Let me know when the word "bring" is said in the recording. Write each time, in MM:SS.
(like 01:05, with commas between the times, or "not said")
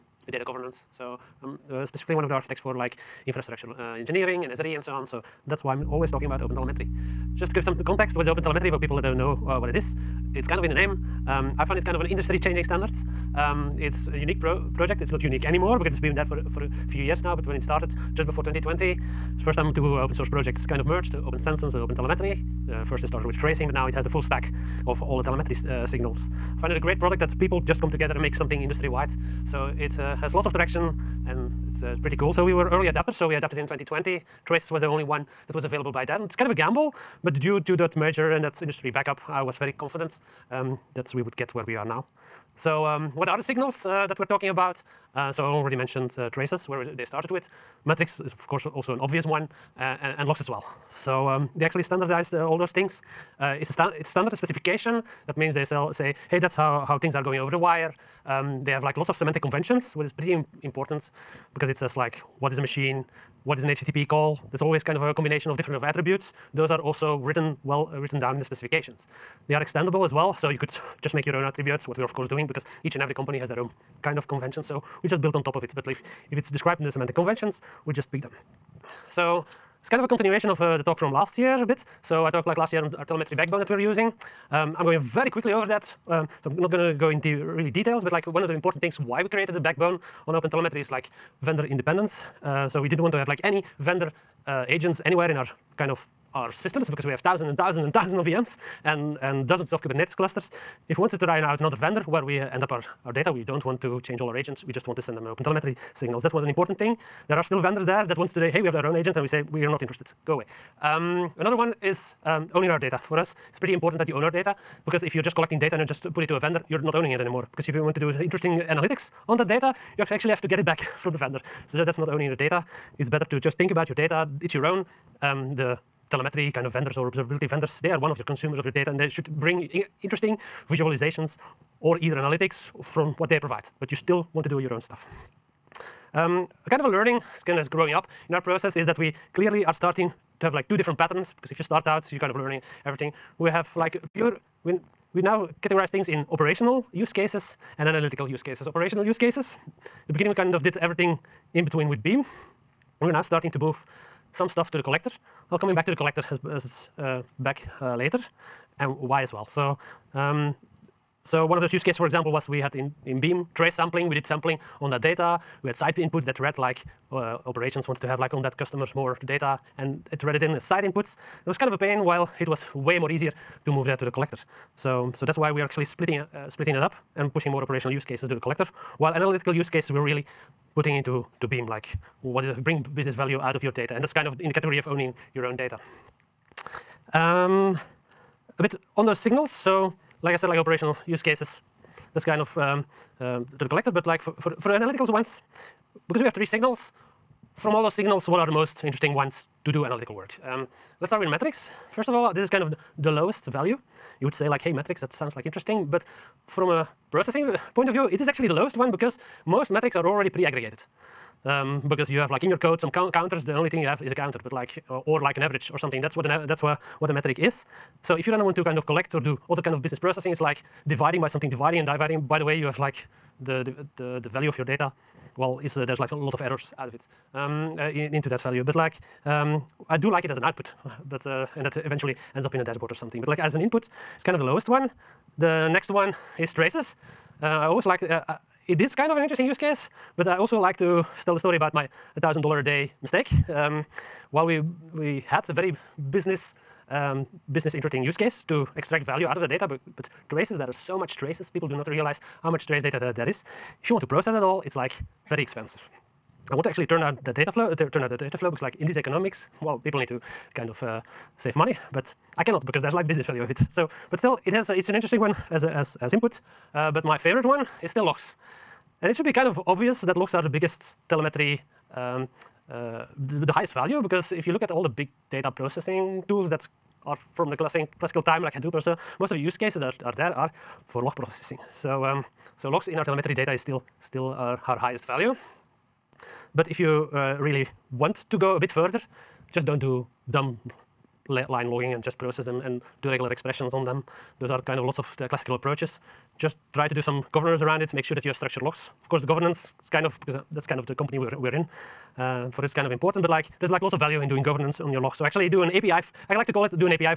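02:09, 03:02.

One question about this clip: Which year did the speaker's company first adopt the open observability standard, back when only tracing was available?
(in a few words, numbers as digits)
2020.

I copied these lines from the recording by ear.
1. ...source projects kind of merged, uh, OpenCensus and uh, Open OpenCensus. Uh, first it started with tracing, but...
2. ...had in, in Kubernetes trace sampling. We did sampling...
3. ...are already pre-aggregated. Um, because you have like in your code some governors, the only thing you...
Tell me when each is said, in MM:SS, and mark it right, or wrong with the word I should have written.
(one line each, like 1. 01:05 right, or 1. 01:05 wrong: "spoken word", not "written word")
1. 00:20 wrong: "Telemetry", not "OpenCensus"
2. 02:42 wrong: "Beam", not "Kubernetes"
3. 03:29 wrong: "counters", not "governors".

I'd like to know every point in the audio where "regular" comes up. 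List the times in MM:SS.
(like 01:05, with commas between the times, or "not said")
04:53.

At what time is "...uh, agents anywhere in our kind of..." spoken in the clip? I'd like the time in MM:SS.
01:34.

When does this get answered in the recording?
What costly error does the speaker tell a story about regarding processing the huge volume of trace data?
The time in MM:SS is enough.
04:02.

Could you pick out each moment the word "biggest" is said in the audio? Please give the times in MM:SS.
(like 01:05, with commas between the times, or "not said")
04:30.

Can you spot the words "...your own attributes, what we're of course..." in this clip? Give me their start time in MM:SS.
01:11.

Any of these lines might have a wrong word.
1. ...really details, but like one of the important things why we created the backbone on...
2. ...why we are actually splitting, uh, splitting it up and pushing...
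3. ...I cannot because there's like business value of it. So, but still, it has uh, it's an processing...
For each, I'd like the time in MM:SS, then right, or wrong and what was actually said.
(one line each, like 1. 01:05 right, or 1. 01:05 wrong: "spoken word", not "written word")
1. 01:27 right
2. 02:55 right
3. 04:22 wrong: "interesting", not "processing".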